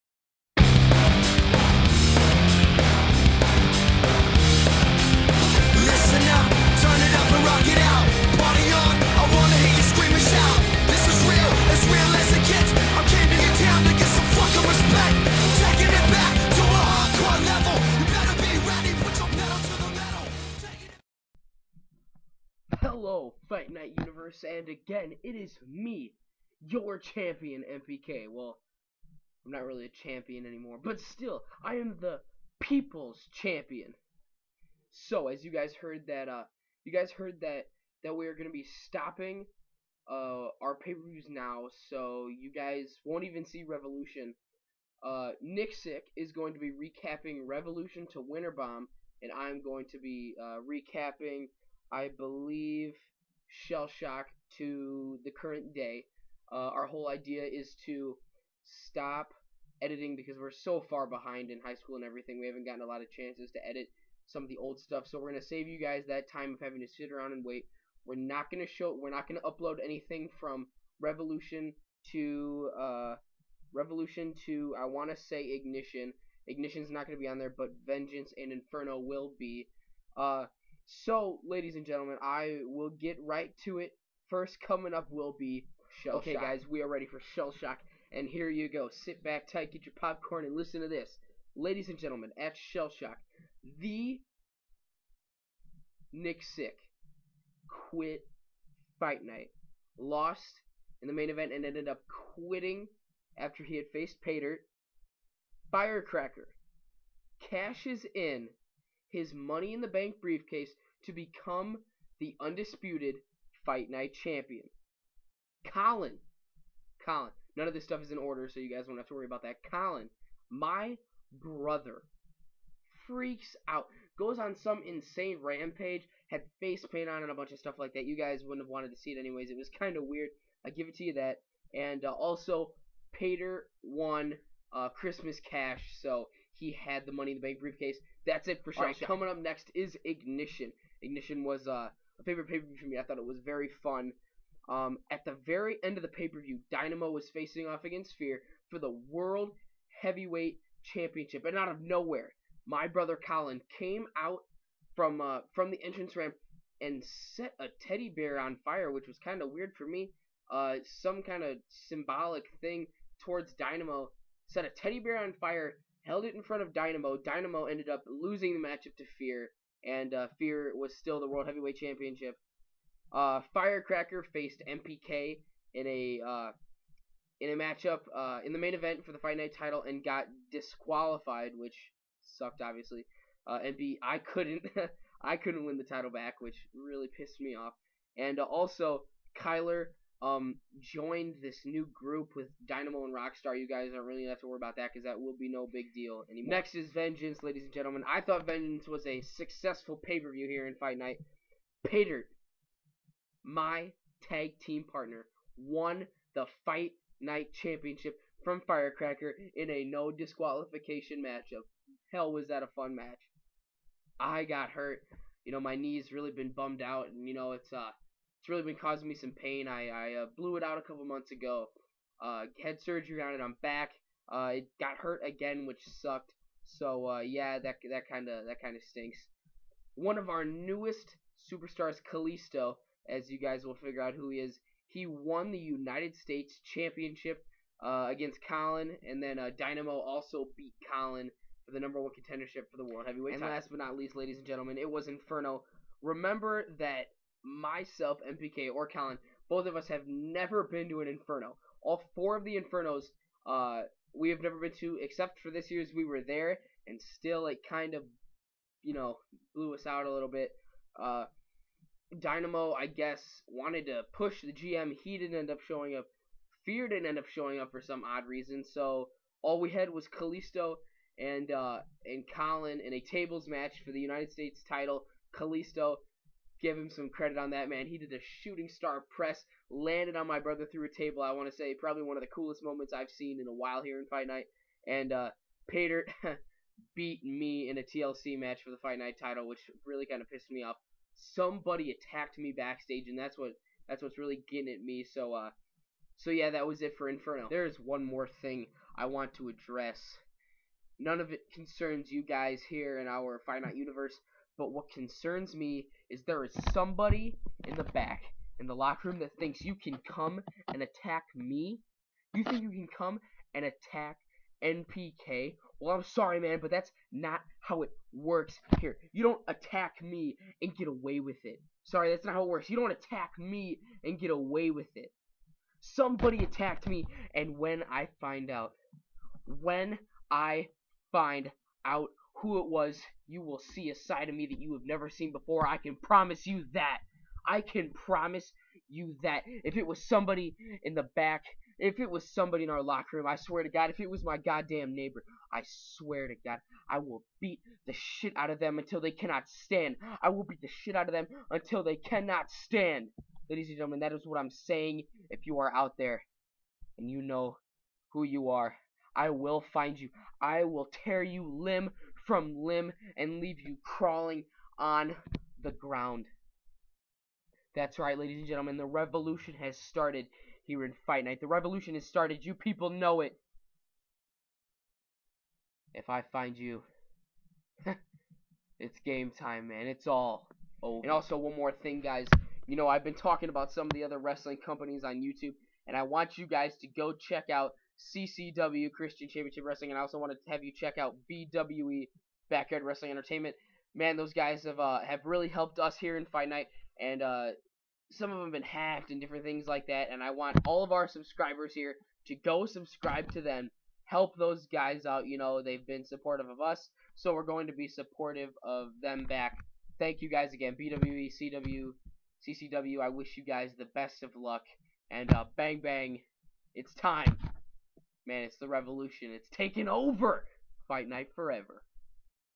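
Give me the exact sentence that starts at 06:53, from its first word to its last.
I wish you guys the best of luck, and uh, bang bang, it's time.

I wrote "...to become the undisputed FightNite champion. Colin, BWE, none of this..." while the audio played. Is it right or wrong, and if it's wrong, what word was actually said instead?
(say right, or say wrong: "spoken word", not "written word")
wrong: "Colin", not "BWE".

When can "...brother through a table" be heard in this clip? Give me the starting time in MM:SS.
04:40.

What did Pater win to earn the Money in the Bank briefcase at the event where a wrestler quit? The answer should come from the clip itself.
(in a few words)
Christmas Cash.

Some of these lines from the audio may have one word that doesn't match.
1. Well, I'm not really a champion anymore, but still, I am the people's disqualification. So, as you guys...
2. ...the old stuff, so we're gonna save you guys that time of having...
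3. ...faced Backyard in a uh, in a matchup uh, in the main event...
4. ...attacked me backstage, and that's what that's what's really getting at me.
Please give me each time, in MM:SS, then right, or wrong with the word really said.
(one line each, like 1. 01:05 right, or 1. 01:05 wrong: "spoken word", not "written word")
1. 00:28 wrong: "champion", not "disqualification"
2. 01:04 right
3. 02:54 wrong: "MPK", not "Backyard"
4. 04:51 right.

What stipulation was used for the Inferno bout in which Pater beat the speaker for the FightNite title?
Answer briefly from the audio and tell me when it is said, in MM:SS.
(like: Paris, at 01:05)
TLC, at 04:47.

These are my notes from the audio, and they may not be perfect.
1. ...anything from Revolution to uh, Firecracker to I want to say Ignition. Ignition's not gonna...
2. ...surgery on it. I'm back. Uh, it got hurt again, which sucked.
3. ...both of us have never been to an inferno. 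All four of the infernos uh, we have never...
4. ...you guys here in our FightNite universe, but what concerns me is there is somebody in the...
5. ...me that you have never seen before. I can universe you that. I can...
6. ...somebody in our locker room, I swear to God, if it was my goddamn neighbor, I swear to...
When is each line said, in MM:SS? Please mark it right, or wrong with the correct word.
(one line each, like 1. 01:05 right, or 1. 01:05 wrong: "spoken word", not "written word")
1. 01:09 wrong: "Revolution", not "Firecracker"
2. 03:42 right
3. 04:09 right
4. 05:02 right
5. 05:34 wrong: "promise", not "universe"
6. 05:42 right.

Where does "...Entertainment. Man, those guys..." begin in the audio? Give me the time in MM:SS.
06:33.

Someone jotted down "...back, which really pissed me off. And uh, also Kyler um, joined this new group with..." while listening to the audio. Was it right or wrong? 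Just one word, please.
right.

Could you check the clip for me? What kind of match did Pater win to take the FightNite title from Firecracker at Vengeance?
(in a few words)
No disqualification.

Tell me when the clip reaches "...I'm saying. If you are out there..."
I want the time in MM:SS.
05:54.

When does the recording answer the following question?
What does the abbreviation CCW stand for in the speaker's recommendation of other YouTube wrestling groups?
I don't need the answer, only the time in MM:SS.
06:28.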